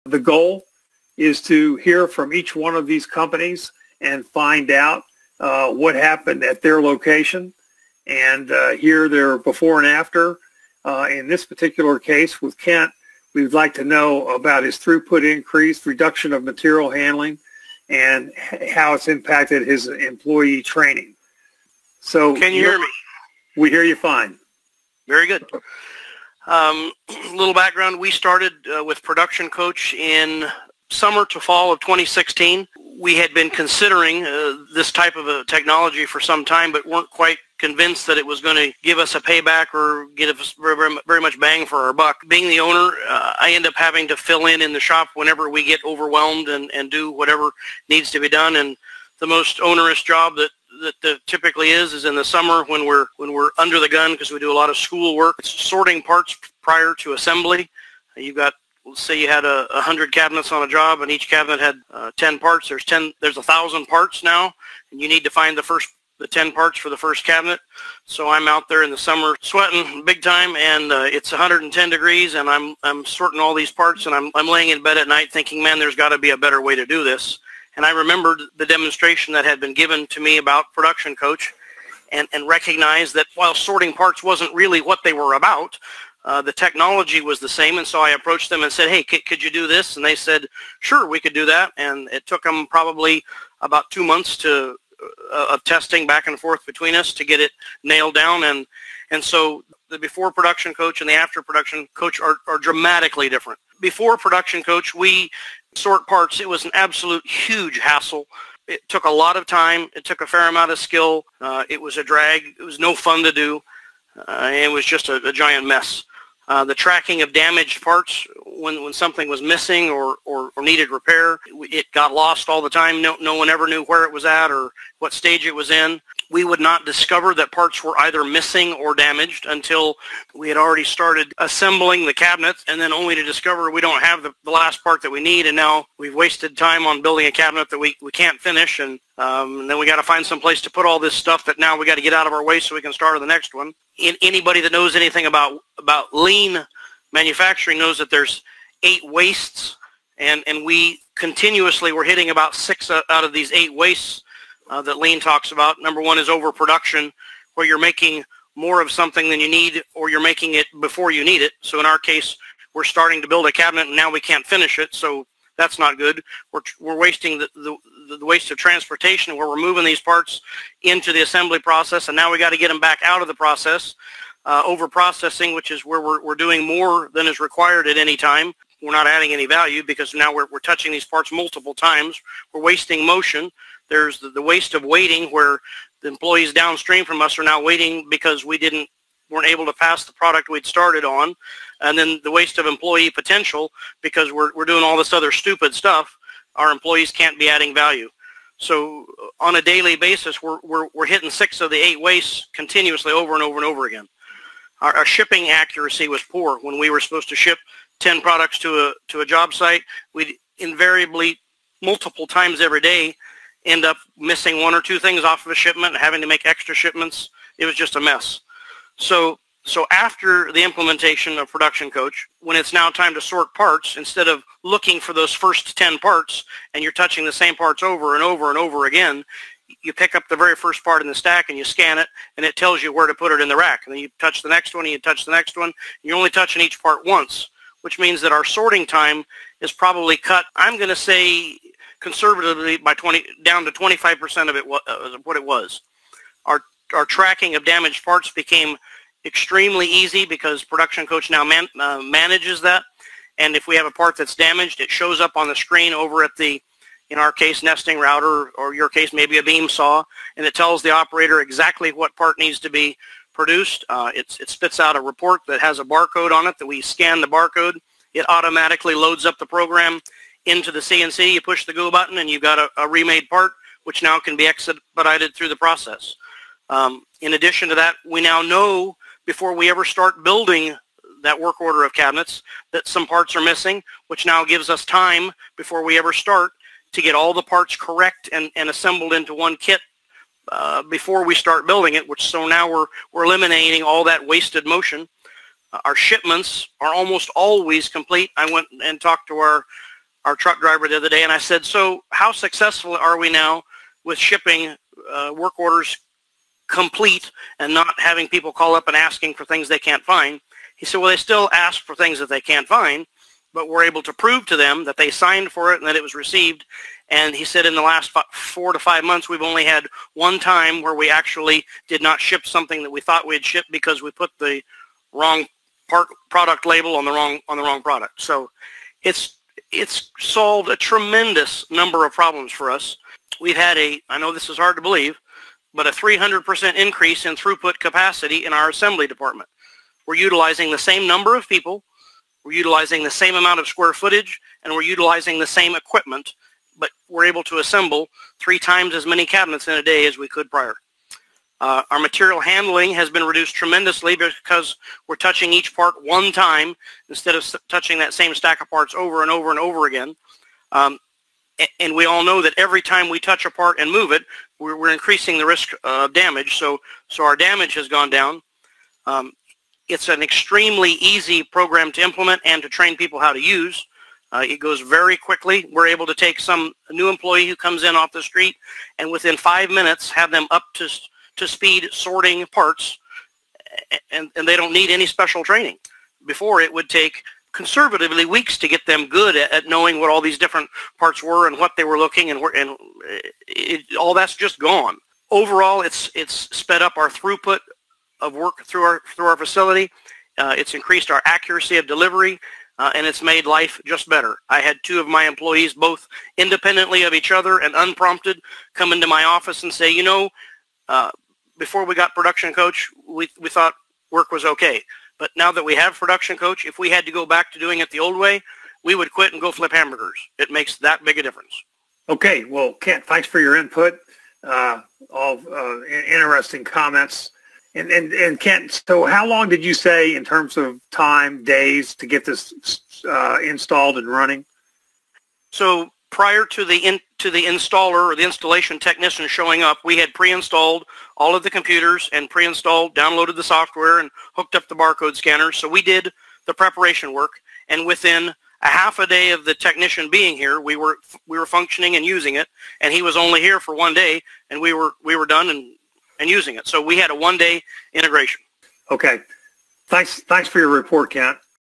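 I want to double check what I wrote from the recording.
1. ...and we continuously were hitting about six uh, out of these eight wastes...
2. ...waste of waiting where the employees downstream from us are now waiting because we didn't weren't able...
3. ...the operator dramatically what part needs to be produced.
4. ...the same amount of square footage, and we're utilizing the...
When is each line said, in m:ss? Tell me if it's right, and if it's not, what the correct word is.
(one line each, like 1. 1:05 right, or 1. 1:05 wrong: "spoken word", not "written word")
1. 2:30 right
2. 3:04 right
3. 4:20 wrong: "exactly", not "dramatically"
4. 5:43 right.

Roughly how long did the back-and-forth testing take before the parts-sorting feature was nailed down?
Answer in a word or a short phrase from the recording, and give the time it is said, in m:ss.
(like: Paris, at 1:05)
two months, at 1:33.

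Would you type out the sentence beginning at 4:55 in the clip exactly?
Uh, our shipments are almost always complete.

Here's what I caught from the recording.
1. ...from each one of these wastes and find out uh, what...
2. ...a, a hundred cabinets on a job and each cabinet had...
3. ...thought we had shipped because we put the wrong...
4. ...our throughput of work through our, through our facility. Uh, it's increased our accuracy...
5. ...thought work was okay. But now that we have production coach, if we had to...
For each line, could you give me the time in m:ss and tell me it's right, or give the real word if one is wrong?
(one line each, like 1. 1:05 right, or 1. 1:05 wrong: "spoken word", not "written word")
1. 0:02 wrong: "companies", not "wastes"
2. 0:59 right
3. 5:23 right
4. 6:36 right
5. 6:53 right.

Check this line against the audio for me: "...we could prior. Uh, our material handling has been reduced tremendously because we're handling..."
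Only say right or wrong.
wrong.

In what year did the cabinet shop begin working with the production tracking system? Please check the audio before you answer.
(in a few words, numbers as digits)
2016.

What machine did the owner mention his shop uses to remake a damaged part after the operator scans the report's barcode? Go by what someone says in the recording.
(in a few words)
nesting router.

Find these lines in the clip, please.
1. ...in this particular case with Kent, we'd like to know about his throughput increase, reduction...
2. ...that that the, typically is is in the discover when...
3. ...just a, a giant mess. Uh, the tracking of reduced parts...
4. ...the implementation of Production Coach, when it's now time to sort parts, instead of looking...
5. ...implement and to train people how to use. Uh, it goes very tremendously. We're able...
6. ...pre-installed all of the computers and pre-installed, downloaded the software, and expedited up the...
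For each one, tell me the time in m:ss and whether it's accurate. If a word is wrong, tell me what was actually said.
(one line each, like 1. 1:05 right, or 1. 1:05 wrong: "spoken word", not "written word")
1. 0:11 right
2. 0:50 wrong: "summer", not "discover"
3. 1:54 wrong: "damaged", not "reduced"
4. 3:40 right
5. 6:12 wrong: "quickly", not "tremendously"
6. 7:20 wrong: "hooked", not "expedited".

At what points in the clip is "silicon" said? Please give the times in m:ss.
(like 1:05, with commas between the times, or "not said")
not said.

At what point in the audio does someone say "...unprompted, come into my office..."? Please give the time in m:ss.
6:47.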